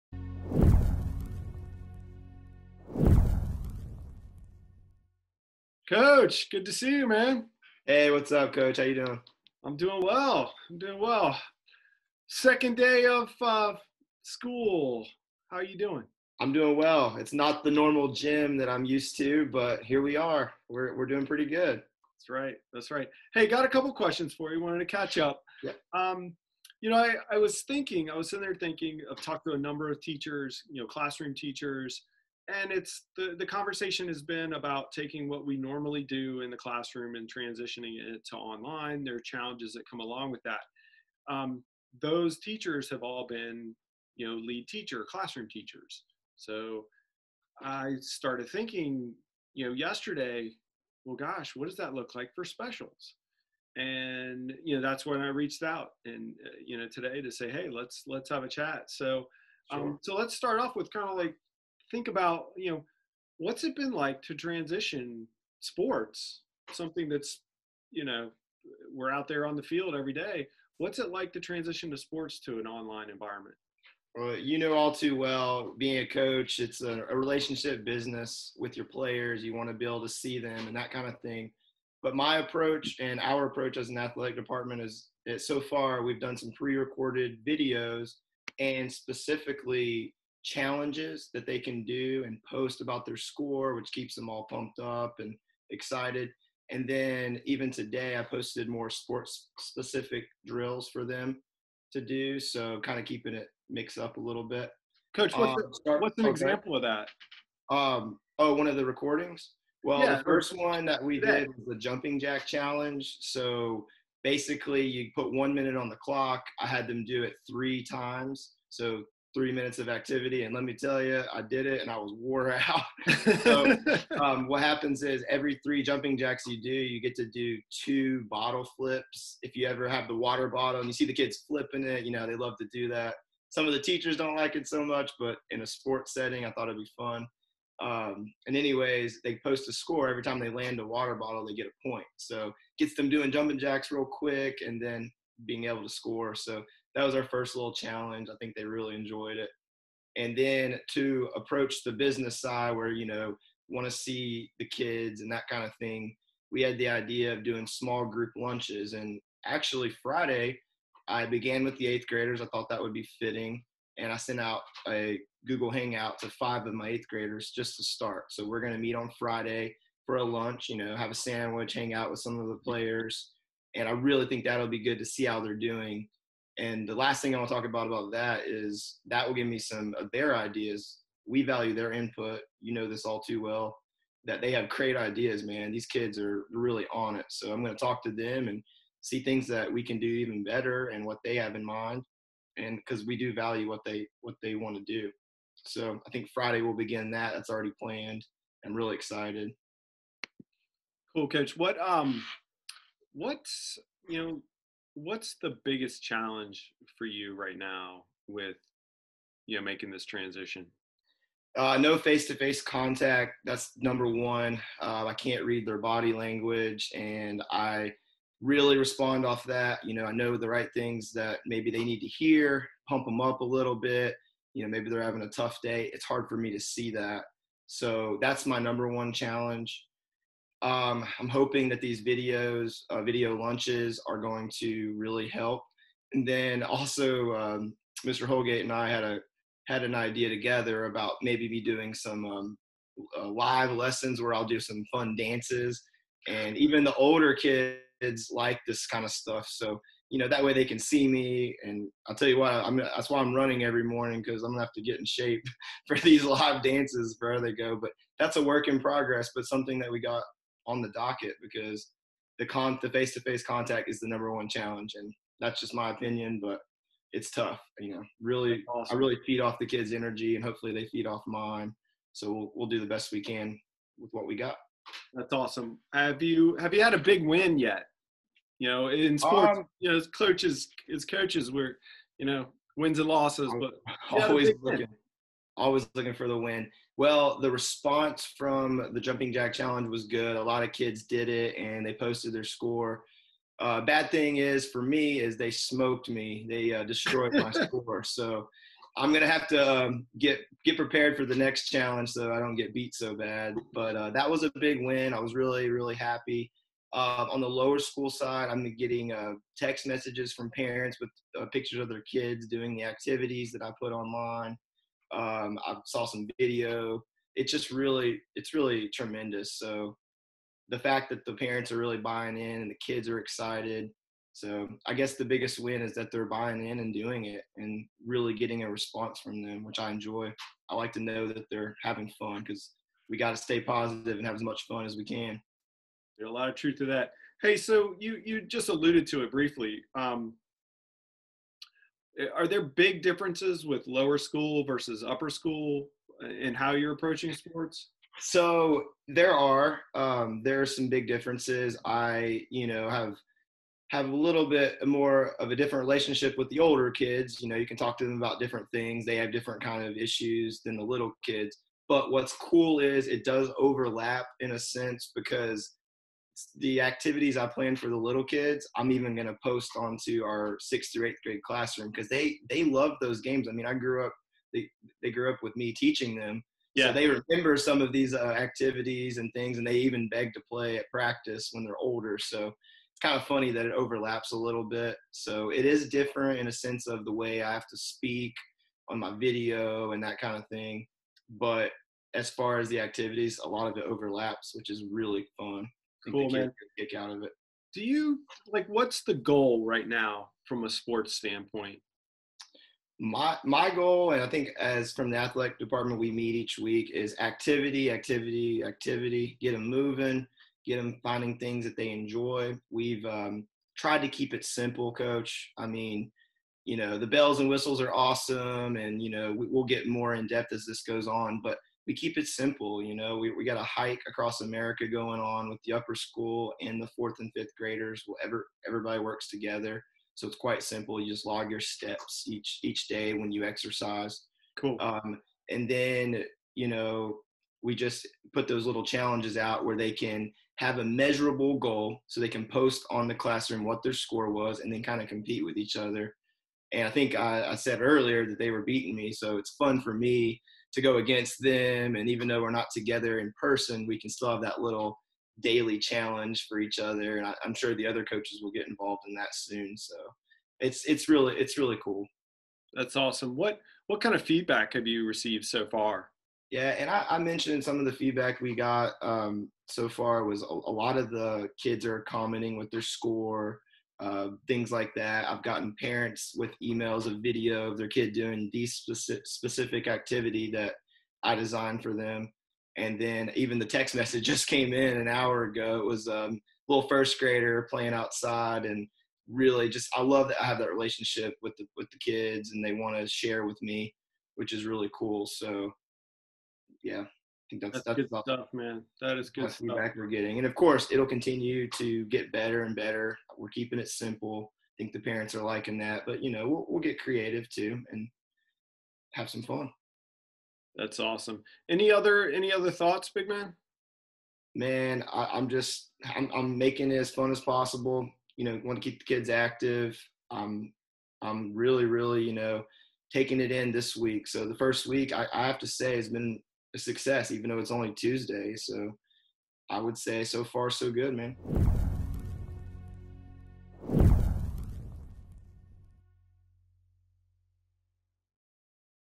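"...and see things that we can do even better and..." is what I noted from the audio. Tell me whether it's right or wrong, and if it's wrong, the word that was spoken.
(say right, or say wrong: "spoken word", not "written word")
right.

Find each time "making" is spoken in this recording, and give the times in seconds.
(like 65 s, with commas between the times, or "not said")
209 s, 516 s.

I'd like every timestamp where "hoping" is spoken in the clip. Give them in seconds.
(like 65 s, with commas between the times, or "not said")
231 s.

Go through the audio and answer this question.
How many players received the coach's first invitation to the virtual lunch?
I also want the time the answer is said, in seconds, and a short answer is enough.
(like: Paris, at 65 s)
5, at 166 s.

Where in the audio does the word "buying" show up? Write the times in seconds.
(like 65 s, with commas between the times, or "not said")
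321 s, 326 s.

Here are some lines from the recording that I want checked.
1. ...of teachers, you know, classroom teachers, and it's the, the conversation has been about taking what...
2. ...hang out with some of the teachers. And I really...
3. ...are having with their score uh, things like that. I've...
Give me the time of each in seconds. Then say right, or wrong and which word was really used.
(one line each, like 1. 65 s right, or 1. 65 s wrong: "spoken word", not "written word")
1. 29 s right
2. 171 s wrong: "players", not "teachers"
3. 471 s wrong: "commenting", not "having".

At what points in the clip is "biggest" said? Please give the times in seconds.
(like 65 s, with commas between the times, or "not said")
205 s, 325 s.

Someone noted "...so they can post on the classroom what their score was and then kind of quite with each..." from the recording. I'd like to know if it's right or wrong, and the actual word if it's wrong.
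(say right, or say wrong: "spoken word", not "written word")
wrong: "compete", not "quite".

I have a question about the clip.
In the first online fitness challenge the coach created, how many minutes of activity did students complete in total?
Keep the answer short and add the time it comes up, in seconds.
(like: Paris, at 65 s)
3, at 119 s.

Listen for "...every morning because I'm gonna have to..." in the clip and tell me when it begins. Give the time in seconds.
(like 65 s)
253 s.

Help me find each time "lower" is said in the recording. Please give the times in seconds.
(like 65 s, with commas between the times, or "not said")
307 s, 343 s.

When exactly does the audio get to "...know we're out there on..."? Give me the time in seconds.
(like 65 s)
68 s.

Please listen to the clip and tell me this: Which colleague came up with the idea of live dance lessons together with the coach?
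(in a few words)
Mr. Holgate.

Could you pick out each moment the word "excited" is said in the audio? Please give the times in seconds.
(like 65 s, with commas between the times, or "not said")
95 s, 198 s, 323 s.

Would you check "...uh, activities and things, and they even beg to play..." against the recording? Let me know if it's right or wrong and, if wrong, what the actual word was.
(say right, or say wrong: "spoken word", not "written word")
right.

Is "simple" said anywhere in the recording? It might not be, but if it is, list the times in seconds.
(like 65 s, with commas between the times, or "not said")
414 s, 422 s, 430 s, 503 s.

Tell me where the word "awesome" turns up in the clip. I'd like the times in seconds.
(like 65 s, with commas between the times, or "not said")
268 s, 275 s, 417 s, 462 s, 510 s.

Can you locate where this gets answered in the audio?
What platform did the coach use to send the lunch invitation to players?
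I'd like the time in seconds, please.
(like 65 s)
165 s.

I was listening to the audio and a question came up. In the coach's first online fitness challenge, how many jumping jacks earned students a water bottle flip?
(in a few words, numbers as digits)
3.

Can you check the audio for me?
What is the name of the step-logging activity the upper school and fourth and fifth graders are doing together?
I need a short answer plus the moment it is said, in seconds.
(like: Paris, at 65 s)
Hike across America, at 423 s.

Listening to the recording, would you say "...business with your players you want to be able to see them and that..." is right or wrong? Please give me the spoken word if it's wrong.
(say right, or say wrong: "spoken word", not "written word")
right.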